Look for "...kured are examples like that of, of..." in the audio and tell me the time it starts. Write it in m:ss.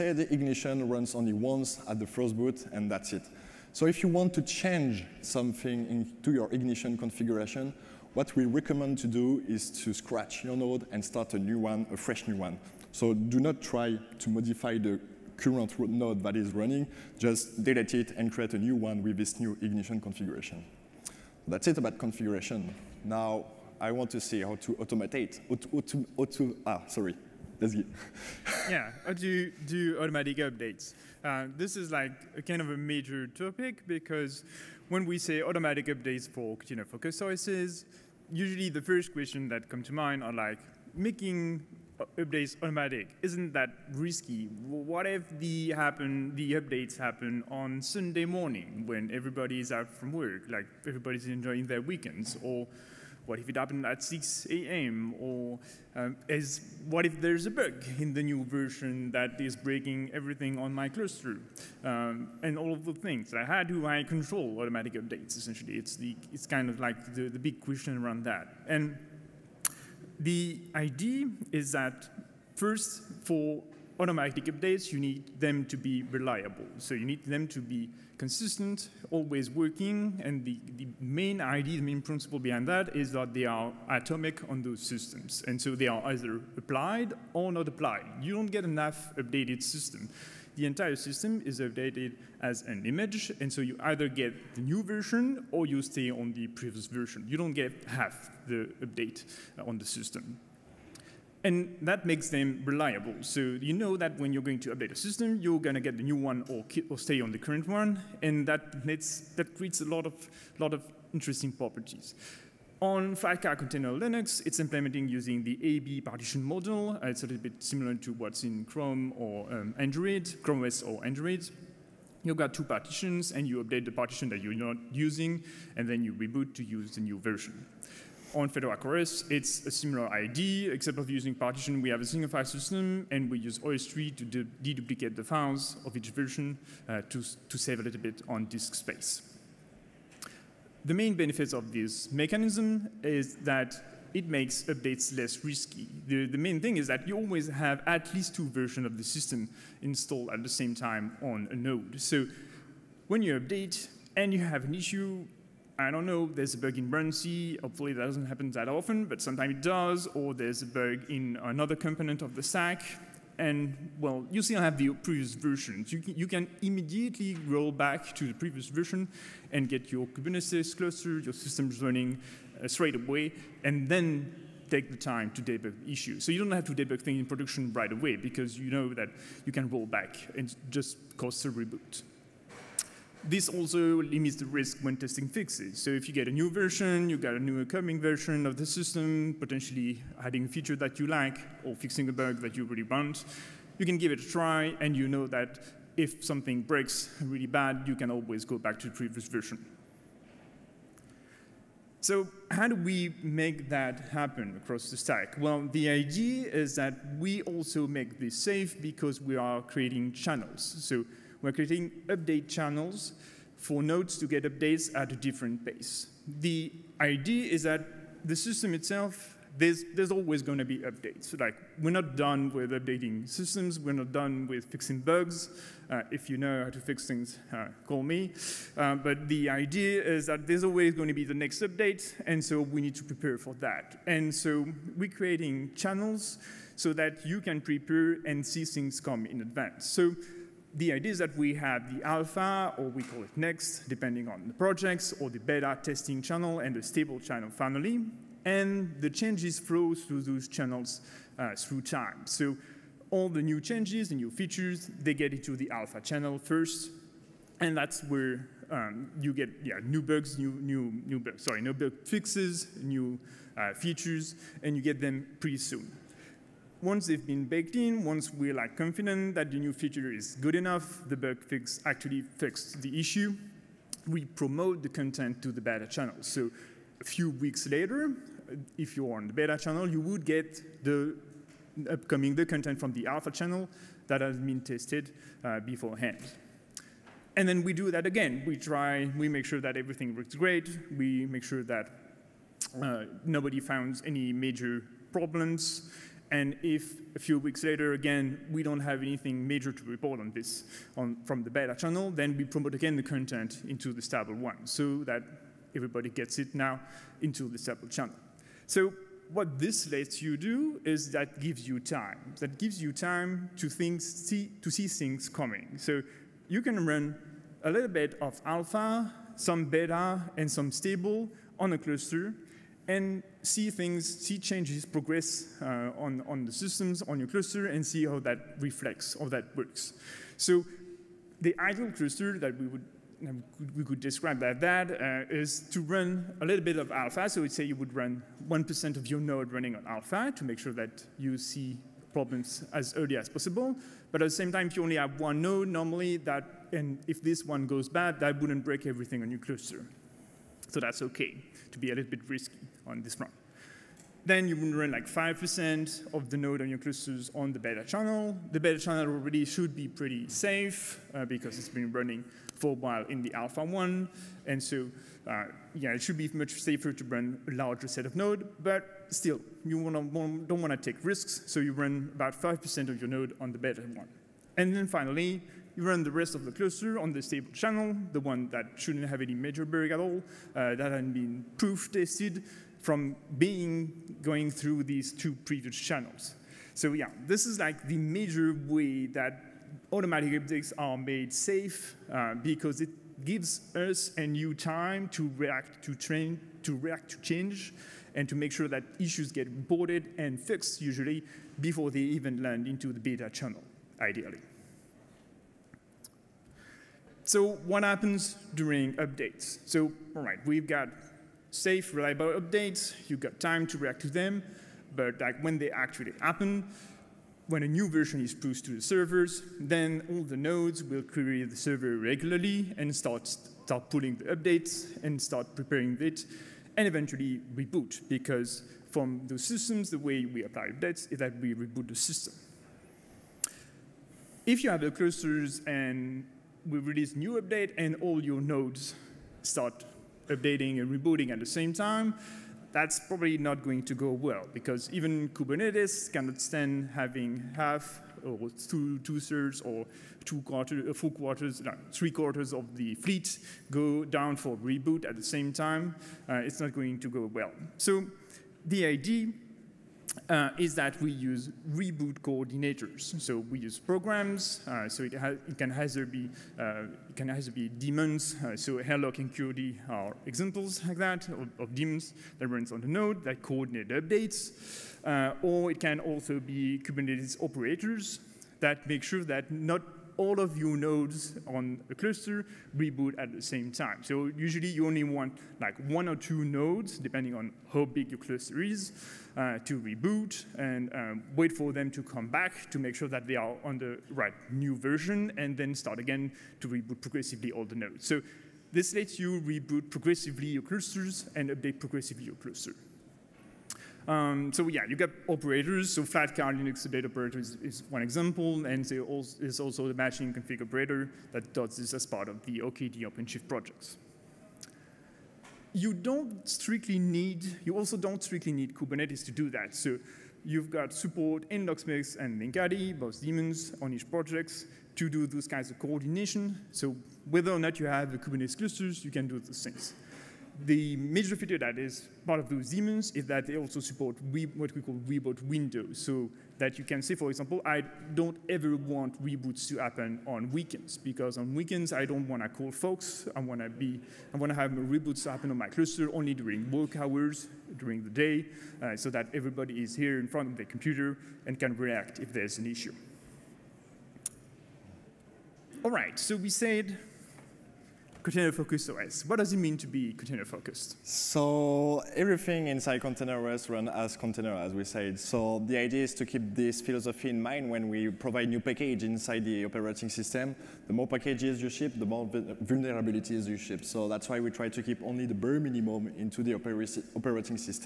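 7:49.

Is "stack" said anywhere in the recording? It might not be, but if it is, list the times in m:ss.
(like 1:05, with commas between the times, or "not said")
2:42, 3:24.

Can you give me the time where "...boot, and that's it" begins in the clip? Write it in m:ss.
0:02.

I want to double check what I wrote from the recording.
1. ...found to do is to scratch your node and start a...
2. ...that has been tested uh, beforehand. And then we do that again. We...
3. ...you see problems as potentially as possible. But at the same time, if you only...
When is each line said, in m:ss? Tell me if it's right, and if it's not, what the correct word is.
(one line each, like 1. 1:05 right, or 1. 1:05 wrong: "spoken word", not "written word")
1. 0:08 wrong: "recommend", not "found"
2. 4:44 right
3. 5:41 wrong: "early", not "potentially".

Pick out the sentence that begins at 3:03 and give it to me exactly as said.
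This also limits the risk when testing fixes.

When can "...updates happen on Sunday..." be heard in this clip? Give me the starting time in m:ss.
0:46.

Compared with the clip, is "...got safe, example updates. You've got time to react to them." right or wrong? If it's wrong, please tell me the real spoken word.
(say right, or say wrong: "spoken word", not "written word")
wrong: "reliable", not "example".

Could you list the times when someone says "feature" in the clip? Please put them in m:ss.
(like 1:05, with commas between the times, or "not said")
3:10, 4:14, 4:23, 4:29, 8:51.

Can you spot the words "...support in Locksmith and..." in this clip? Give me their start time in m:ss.
8:40.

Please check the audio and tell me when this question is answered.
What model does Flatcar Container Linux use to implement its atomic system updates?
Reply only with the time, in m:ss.
1:55.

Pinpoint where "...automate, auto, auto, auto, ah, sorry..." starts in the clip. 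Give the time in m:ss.
0:24.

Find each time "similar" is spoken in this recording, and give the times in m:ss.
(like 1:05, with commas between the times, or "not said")
1:57, 2:09.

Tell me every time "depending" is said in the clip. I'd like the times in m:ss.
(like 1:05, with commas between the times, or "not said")
4:03, 8:06.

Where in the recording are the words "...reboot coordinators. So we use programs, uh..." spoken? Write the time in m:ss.
7:41.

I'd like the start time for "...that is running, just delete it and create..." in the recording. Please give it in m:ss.
0:16.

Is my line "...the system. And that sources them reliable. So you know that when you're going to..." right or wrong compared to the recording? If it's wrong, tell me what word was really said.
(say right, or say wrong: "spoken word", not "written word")
wrong: "makes", not "sources".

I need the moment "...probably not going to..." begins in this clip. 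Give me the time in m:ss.
7:22.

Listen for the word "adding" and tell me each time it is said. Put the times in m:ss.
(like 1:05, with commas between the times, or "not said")
3:10.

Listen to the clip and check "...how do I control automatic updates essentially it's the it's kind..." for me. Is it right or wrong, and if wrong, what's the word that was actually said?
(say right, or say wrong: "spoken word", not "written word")
right.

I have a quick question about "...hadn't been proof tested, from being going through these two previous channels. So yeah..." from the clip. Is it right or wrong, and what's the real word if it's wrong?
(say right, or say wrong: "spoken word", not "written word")
right.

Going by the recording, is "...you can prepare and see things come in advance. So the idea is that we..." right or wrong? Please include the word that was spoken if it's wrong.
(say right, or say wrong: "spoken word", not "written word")
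right.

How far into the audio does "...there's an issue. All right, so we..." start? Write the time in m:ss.
9:12.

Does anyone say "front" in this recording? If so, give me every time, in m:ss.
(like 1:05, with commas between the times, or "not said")
5:53, 9:10.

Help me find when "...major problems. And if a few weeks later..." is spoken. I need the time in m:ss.
4:54.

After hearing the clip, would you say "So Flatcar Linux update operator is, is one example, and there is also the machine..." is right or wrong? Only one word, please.
right.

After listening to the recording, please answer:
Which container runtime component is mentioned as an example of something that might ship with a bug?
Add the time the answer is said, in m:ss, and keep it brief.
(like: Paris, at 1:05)
runc, at 2:36.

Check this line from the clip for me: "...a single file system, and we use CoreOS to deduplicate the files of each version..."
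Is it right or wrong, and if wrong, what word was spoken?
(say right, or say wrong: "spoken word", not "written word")
wrong: "OSTree", not "CoreOS".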